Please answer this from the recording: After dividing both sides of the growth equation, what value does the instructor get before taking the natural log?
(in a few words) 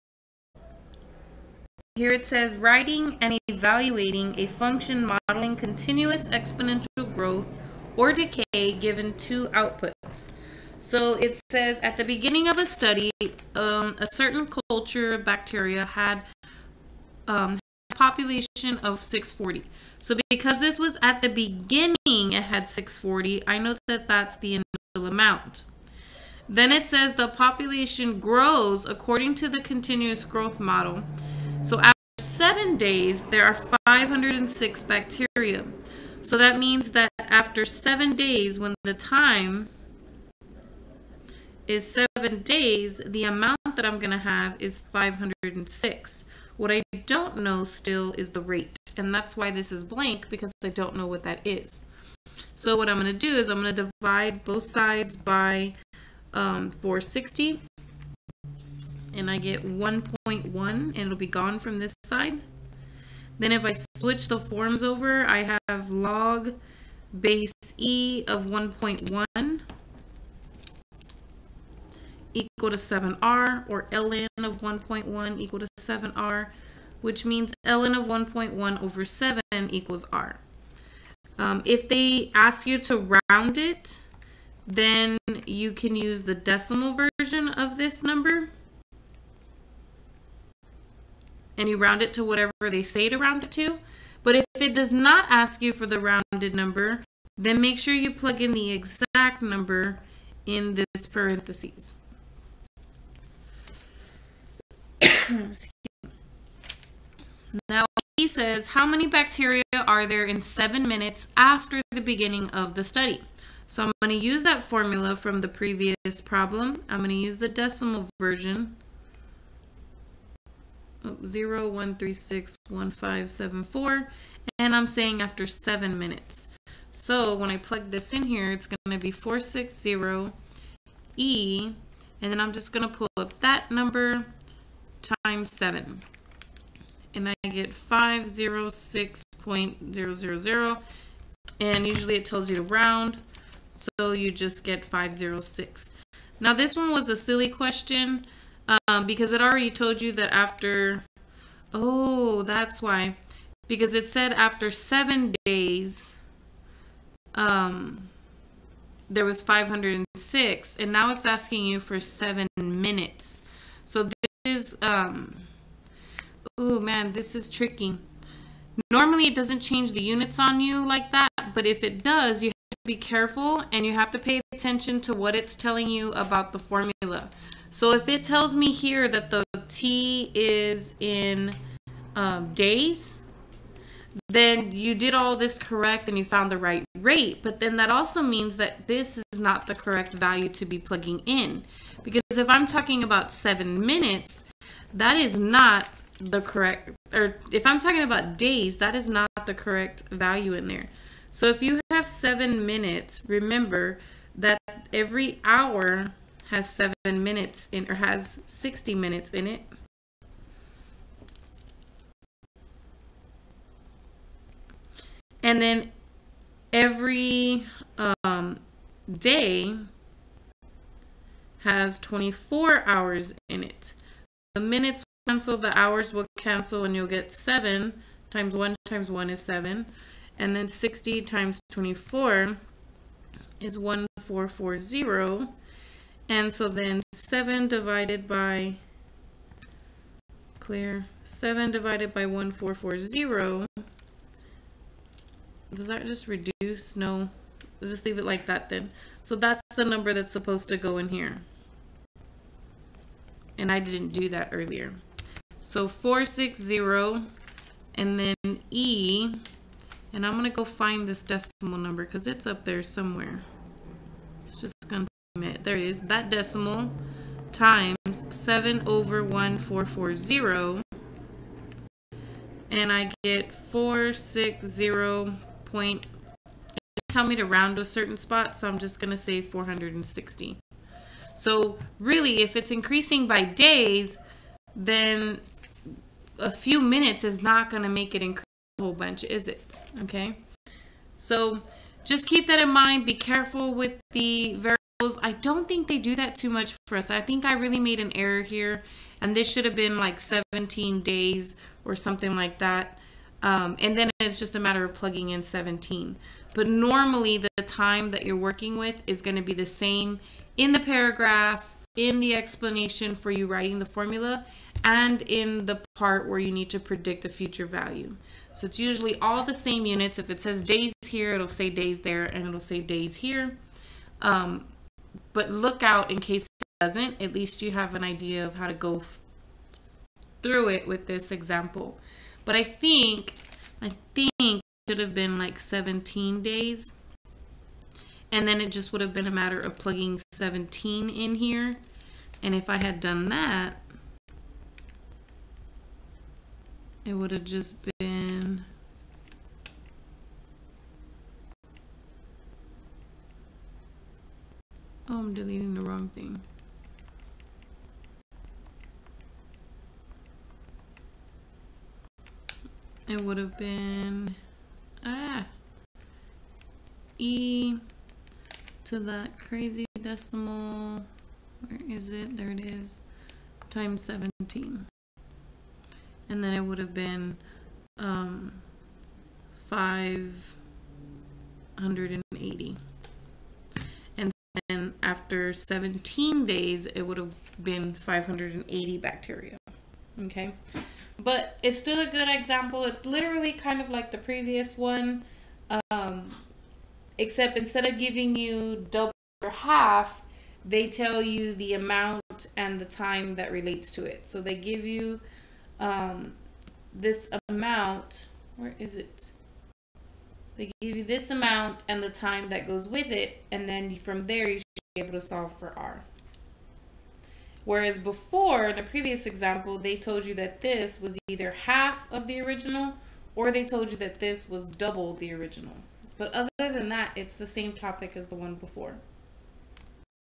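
1.1.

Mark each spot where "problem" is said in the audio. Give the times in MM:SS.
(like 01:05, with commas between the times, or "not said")
01:56.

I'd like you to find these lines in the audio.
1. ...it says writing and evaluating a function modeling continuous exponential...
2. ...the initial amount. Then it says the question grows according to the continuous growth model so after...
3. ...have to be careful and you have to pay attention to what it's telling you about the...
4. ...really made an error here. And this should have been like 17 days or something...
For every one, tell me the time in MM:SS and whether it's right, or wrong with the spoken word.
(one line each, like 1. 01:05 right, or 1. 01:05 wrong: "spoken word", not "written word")
1. 00:02 right
2. 00:24 wrong: "population", not "question"
3. 02:52 right
4. 04:57 right.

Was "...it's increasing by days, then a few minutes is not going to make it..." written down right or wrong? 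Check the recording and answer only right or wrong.
right.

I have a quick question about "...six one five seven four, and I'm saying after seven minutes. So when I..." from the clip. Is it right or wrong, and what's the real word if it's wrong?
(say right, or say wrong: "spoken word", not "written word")
right.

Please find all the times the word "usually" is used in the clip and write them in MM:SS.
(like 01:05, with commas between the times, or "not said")
02:21, 05:18.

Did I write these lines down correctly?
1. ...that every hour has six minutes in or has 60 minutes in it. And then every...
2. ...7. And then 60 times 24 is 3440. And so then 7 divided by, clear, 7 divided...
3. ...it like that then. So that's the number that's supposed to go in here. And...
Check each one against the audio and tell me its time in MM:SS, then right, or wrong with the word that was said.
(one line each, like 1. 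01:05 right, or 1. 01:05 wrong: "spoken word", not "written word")
1. 03:24 wrong: "seven", not "six"
2. 03:49 wrong: "1440", not "3440"
3. 04:08 right.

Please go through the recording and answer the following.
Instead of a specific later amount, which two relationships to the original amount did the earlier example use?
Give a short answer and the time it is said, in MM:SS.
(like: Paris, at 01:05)
double or half, at 06:38.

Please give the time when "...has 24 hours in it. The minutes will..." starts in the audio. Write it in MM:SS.
03:41.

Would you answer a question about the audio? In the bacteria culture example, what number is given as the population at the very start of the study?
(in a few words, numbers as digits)
640.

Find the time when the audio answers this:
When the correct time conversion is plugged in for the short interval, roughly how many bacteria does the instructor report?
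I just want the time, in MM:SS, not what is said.
04:38.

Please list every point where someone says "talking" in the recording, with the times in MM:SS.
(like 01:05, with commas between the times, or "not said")
03:12, 03:17.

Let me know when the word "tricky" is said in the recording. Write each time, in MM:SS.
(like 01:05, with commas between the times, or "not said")
02:47.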